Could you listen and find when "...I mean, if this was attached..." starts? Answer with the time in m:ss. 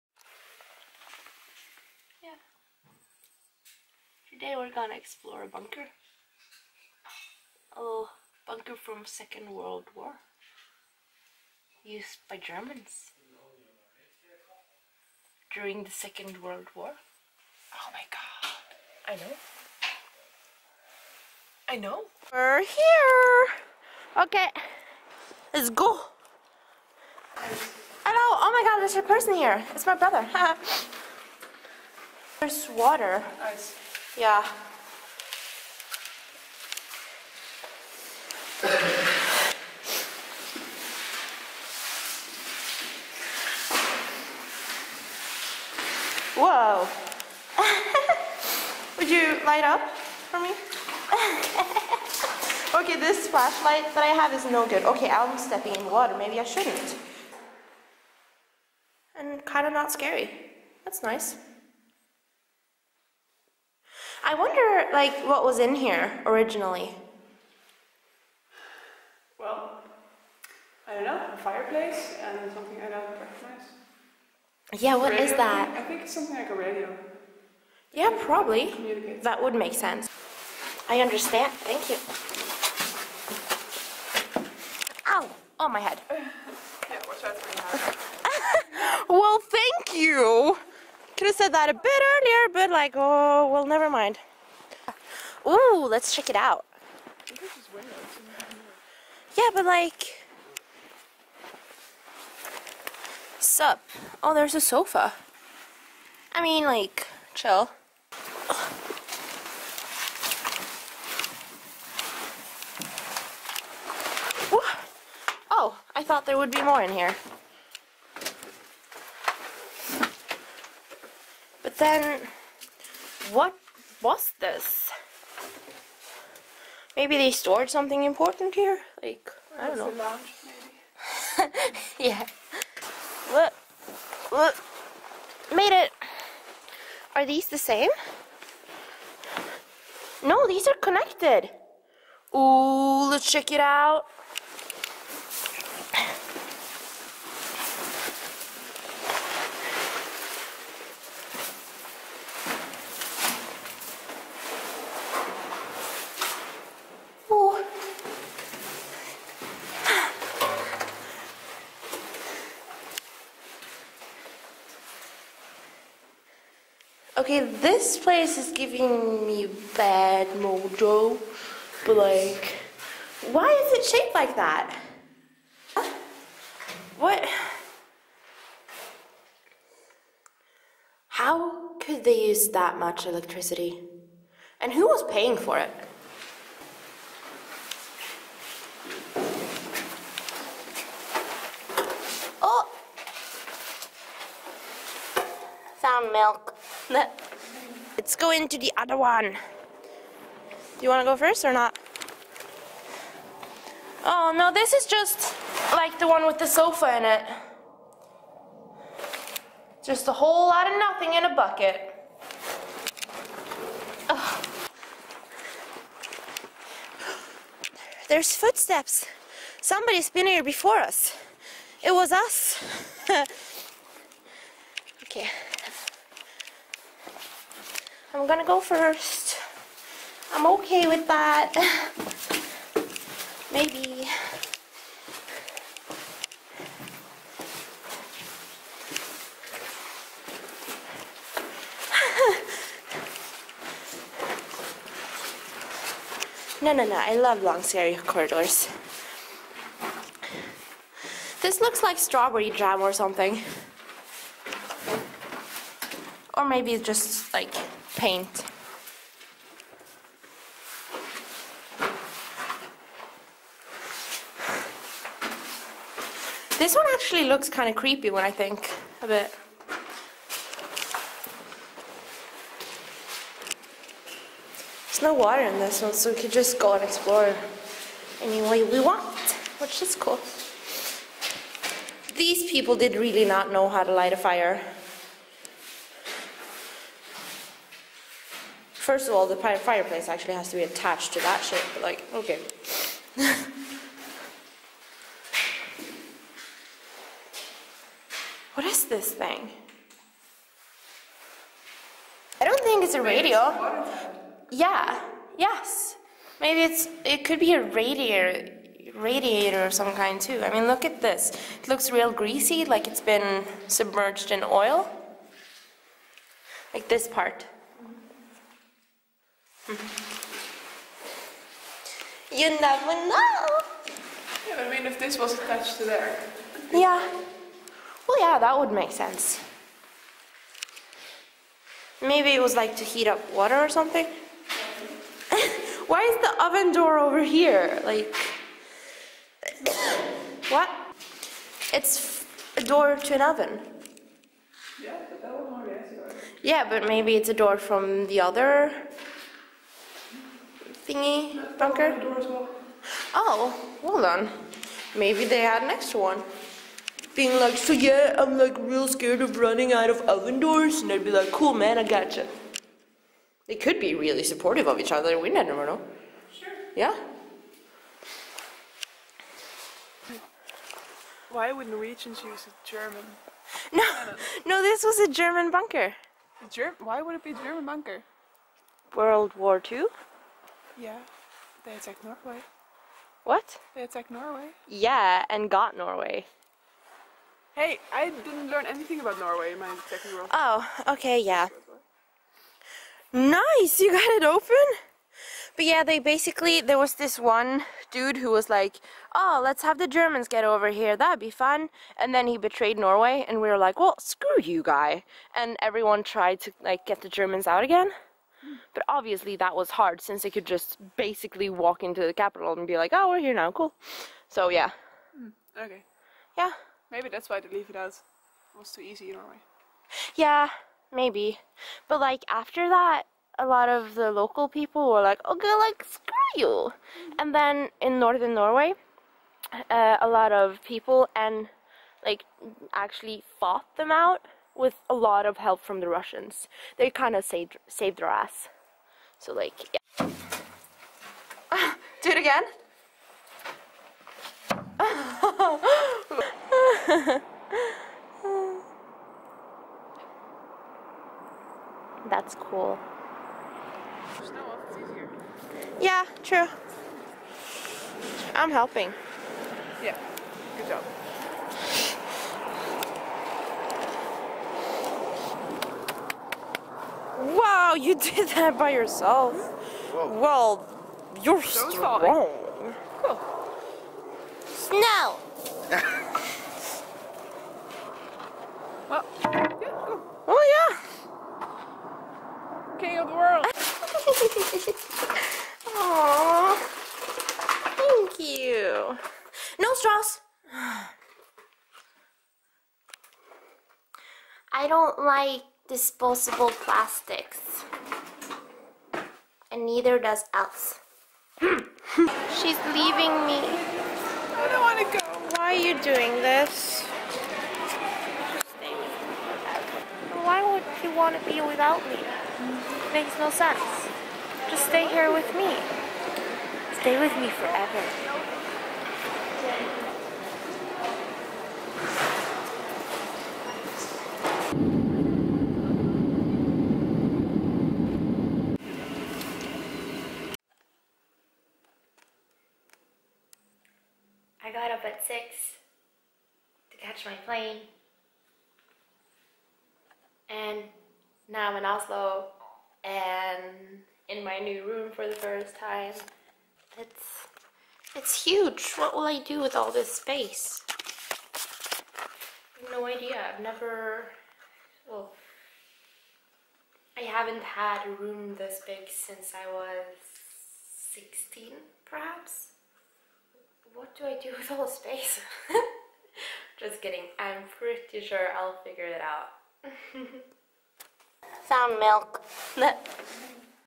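5:24.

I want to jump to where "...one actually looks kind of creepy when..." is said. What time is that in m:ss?
4:26.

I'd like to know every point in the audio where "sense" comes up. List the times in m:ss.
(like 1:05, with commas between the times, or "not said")
1:19, 5:28, 8:33.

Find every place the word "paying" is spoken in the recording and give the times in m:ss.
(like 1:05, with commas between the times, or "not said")
3:05.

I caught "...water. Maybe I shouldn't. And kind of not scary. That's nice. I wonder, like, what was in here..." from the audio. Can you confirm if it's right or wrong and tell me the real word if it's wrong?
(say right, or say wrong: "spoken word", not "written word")
right.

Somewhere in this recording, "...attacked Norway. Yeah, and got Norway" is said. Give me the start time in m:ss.
6:23.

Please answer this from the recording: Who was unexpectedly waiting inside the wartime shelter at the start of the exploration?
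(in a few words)
My brother.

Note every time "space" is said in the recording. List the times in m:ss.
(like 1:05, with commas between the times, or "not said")
9:09, 9:24.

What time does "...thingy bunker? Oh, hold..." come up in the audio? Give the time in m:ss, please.
5:50.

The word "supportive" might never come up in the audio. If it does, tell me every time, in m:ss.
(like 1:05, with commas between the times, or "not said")
6:04.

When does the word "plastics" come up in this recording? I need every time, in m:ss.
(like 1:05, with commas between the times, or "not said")
8:16.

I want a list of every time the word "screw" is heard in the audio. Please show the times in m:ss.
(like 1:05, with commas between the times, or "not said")
6:43, 7:05.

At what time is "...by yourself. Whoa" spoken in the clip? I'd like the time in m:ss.
7:48.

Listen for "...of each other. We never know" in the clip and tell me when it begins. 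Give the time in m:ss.
6:04.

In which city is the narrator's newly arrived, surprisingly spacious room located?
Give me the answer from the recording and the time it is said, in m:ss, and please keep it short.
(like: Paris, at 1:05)
Oslo, at 9:01.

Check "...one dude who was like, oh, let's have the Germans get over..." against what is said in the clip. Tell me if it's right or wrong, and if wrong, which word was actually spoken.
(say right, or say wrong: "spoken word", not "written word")
right.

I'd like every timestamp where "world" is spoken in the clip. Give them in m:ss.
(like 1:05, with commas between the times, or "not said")
0:09, 0:16, 6:18, 6:30, 8:03.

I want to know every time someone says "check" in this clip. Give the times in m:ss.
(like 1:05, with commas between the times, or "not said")
1:36, 2:23.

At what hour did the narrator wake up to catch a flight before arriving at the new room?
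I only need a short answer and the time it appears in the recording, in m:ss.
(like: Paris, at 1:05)
6, at 8:55.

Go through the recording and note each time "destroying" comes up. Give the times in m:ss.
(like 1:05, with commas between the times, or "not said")
not said.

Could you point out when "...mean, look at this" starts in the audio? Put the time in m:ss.
5:10.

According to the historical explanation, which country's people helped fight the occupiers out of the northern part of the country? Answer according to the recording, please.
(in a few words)
Russians.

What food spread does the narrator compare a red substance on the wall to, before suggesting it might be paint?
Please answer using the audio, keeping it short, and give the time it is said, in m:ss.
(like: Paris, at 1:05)
Strawberry jam, at 4:11.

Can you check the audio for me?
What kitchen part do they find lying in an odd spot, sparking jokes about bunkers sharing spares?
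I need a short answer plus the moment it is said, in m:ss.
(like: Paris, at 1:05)
Oven door, at 5:36.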